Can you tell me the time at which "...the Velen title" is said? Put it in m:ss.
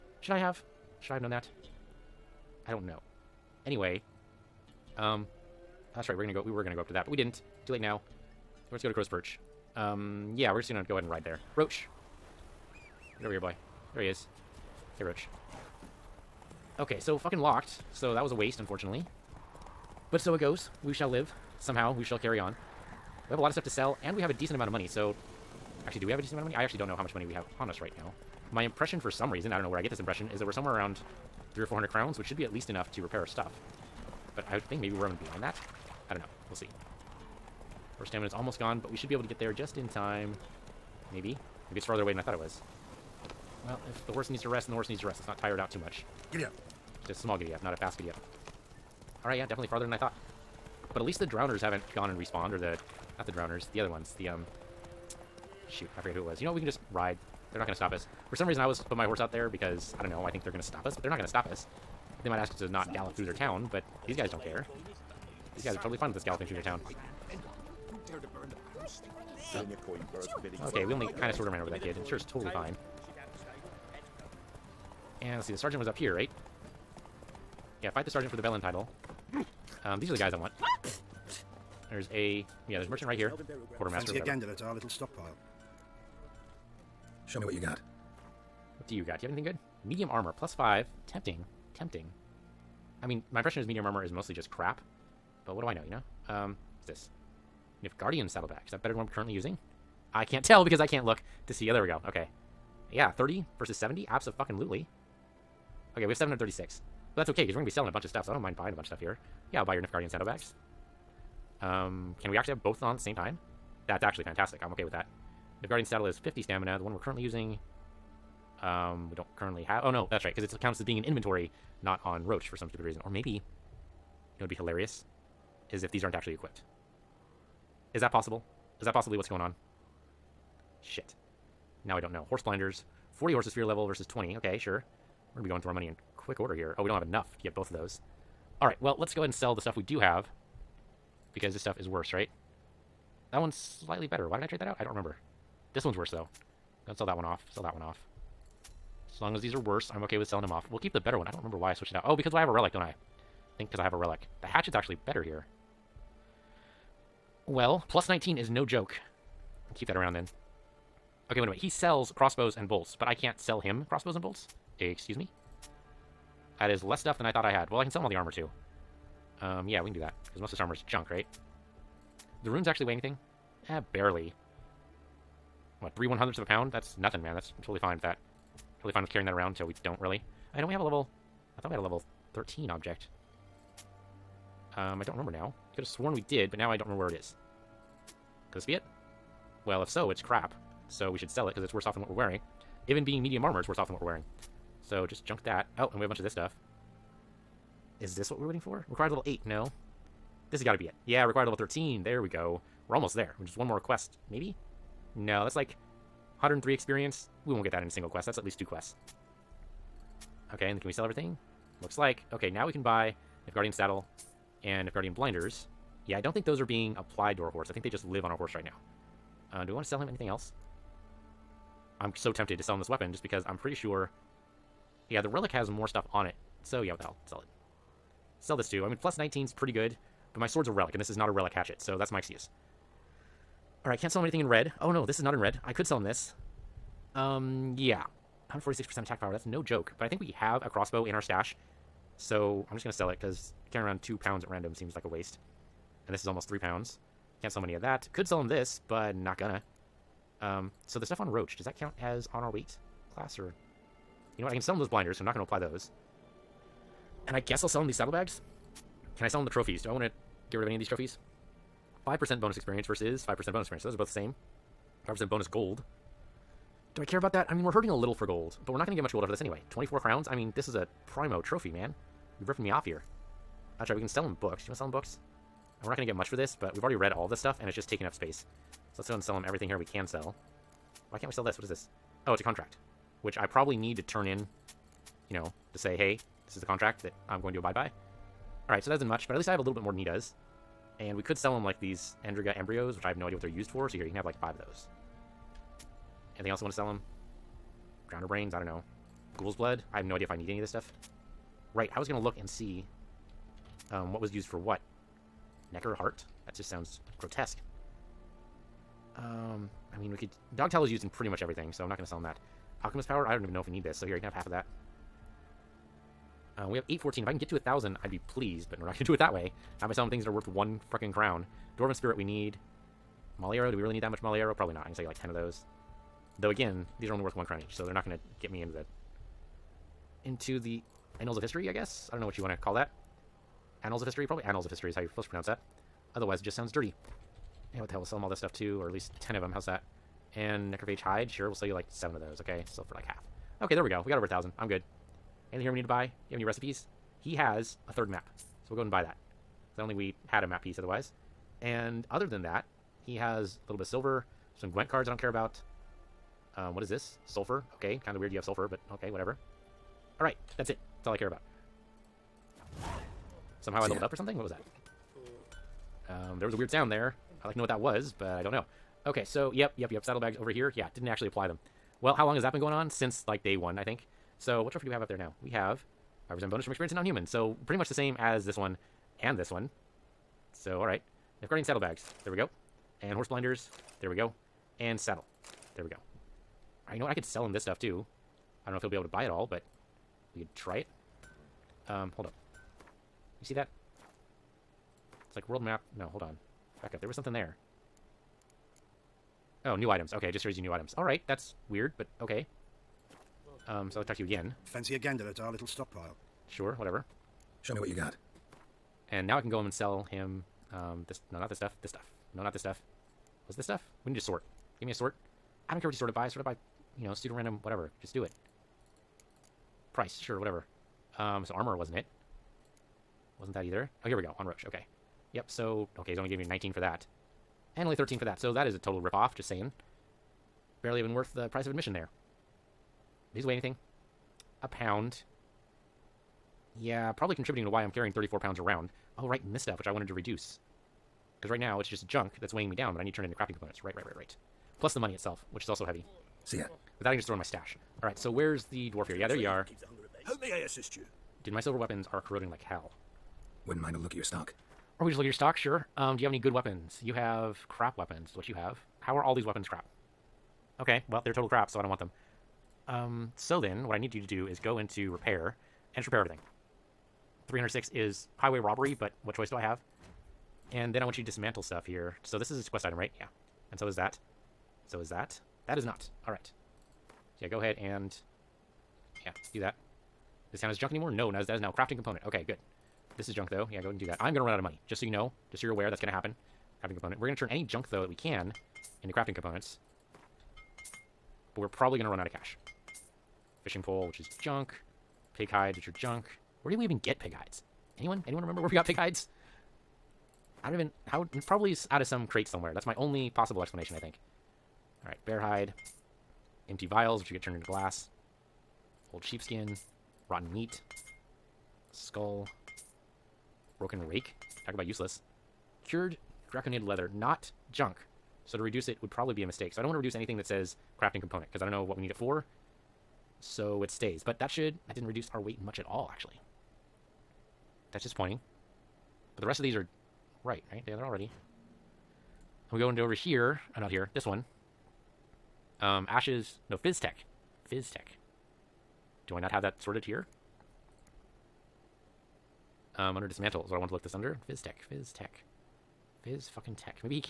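1:18.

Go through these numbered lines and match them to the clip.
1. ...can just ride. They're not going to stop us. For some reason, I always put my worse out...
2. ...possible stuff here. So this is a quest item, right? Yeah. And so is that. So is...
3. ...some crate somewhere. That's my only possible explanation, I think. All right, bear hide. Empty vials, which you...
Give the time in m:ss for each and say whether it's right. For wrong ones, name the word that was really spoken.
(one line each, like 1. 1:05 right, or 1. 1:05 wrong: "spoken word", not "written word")
1. 0:56 wrong: "horse", not "worse"
2. 7:51 wrong: "dismantle", not "possible"
3. 8:22 right.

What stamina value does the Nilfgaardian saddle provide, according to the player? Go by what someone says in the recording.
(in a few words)
50.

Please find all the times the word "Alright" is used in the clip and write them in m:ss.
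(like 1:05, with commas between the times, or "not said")
0:49, 4:48, 6:00.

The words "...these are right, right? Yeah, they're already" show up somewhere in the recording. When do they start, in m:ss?
8:49.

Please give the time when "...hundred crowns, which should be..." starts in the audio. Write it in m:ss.
0:31.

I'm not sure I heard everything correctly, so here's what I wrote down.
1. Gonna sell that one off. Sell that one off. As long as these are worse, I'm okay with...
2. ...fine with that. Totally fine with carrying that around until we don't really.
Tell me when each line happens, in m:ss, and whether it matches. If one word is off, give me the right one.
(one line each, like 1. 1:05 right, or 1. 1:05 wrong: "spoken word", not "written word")
1. 2:26 right
2. 2:57 right.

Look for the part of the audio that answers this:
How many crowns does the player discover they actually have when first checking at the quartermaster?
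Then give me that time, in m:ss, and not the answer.
1:46.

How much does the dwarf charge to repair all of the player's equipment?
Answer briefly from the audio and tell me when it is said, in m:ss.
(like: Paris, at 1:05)
306, at 7:47.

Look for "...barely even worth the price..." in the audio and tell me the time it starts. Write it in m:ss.
7:10.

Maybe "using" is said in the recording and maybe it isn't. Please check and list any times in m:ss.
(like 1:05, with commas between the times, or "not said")
1:39, 1:57.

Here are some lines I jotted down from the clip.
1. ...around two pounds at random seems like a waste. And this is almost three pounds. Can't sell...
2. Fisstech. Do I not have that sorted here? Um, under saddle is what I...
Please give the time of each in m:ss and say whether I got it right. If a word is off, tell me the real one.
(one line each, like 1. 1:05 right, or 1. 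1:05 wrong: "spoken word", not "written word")
1. 4:03 right
2. 8:57 wrong: "dismantle", not "saddle".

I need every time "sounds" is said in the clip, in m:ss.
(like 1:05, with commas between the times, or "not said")
5:06, 5:36, 6:06.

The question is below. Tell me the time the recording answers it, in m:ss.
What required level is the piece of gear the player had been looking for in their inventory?
3:21.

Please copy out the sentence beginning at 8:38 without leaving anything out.
So to reduce it would probably be a mistake.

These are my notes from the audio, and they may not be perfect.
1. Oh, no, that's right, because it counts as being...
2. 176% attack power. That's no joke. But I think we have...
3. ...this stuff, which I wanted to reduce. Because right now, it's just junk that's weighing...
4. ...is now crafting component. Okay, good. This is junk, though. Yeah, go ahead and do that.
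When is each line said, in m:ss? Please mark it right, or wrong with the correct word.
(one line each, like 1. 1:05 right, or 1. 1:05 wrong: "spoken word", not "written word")
1. 1:59 right
2. 3:58 wrong: "146", not "176"
3. 7:19 right
4. 8:01 right.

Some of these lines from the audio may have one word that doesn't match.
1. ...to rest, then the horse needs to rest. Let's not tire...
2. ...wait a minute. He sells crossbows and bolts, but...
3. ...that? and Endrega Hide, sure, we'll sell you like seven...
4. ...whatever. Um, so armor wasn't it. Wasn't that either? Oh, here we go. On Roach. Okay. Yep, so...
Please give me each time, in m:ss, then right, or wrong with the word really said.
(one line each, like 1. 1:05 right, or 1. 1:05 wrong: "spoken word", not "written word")
1. 0:44 right
2. 2:41 right
3. 5:39 wrong: "Necrophage", not "Endrega"
4. 7:00 right.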